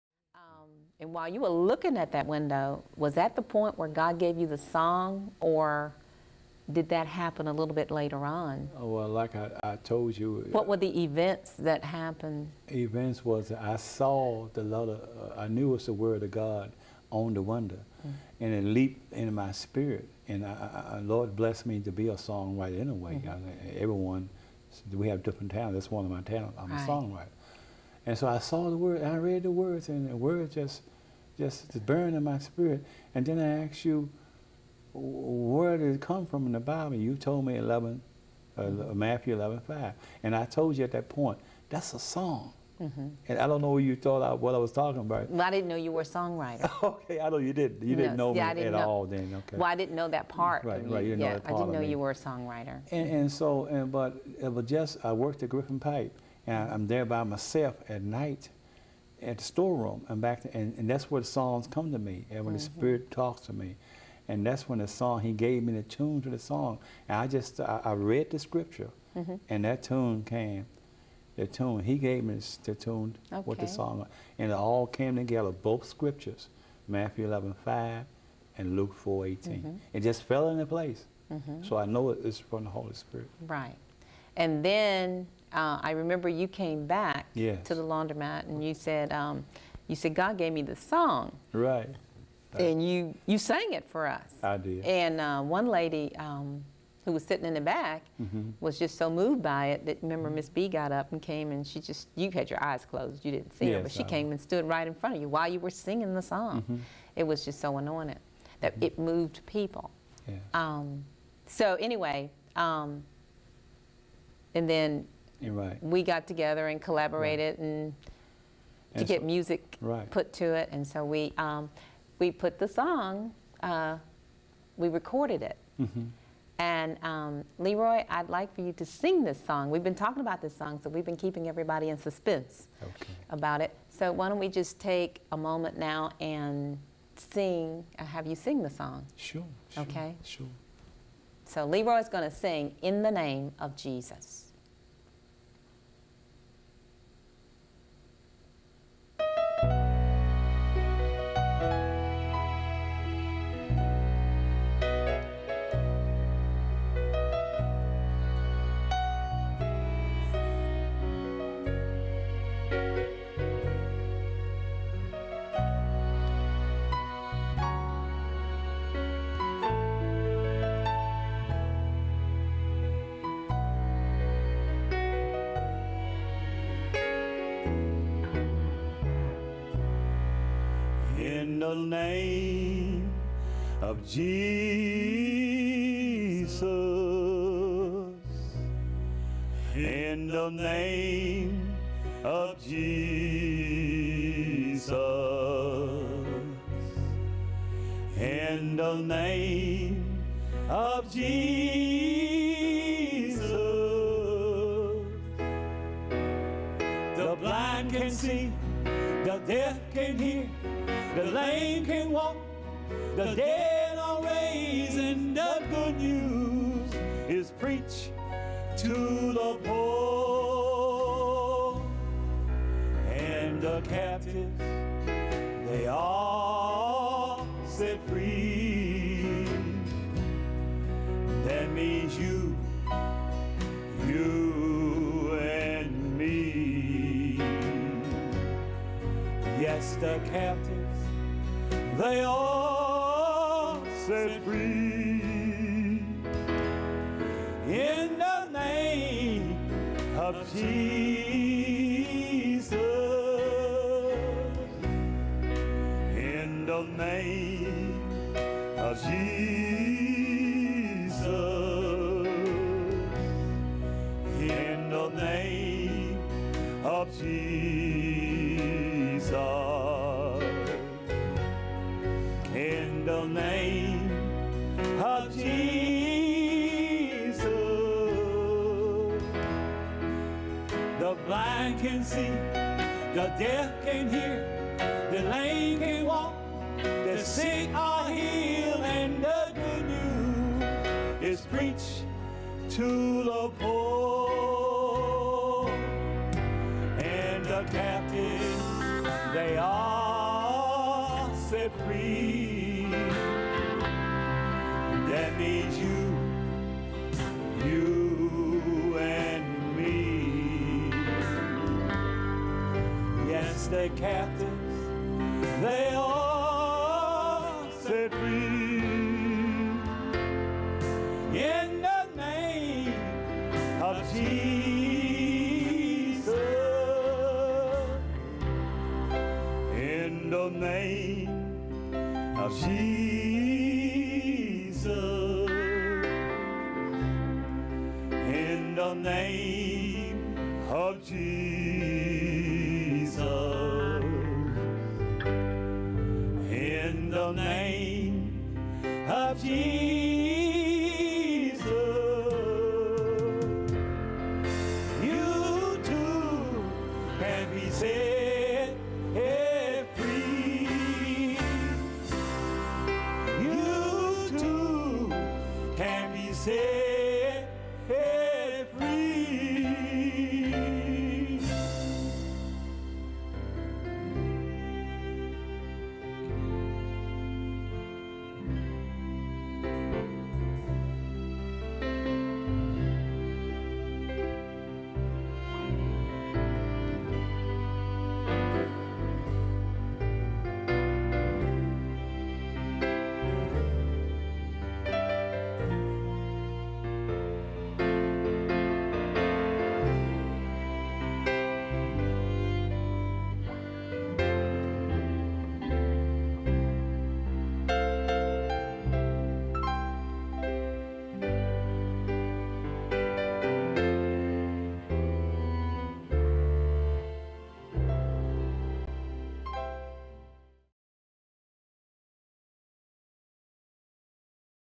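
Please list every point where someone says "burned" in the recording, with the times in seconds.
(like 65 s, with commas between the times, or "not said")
31 s.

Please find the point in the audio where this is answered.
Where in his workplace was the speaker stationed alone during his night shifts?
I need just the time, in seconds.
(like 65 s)
59 s.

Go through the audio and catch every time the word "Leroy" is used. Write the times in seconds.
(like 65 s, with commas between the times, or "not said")
127 s, 141 s.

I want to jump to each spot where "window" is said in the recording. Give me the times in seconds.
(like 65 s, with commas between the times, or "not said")
2 s, 17 s.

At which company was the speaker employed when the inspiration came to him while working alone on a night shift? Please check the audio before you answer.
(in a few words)
Griffin Pipe.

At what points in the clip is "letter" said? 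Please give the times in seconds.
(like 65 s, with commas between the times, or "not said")
14 s.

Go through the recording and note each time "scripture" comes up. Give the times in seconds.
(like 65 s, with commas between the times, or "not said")
68 s, 75 s.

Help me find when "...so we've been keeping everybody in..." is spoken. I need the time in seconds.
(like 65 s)
130 s.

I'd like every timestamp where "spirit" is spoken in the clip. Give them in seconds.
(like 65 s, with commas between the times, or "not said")
19 s, 32 s, 62 s, 82 s.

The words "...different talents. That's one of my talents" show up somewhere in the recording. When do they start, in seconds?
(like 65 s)
25 s.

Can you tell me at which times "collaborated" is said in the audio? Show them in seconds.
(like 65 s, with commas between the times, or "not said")
116 s.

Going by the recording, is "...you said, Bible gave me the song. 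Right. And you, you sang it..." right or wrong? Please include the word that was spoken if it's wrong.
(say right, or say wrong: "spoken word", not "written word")
wrong: "God", not "Bible".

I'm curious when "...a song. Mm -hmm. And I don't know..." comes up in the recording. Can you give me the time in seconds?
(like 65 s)
41 s.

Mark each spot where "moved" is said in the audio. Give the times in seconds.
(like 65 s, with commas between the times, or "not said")
99 s, 108 s.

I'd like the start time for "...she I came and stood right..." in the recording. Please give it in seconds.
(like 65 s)
103 s.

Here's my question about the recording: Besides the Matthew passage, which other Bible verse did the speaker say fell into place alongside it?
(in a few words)
Luke 4:18.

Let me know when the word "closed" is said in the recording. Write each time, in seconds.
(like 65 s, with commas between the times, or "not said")
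102 s.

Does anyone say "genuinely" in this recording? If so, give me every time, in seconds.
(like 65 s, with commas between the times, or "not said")
not said.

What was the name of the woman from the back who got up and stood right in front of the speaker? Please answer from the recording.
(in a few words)
Miss B.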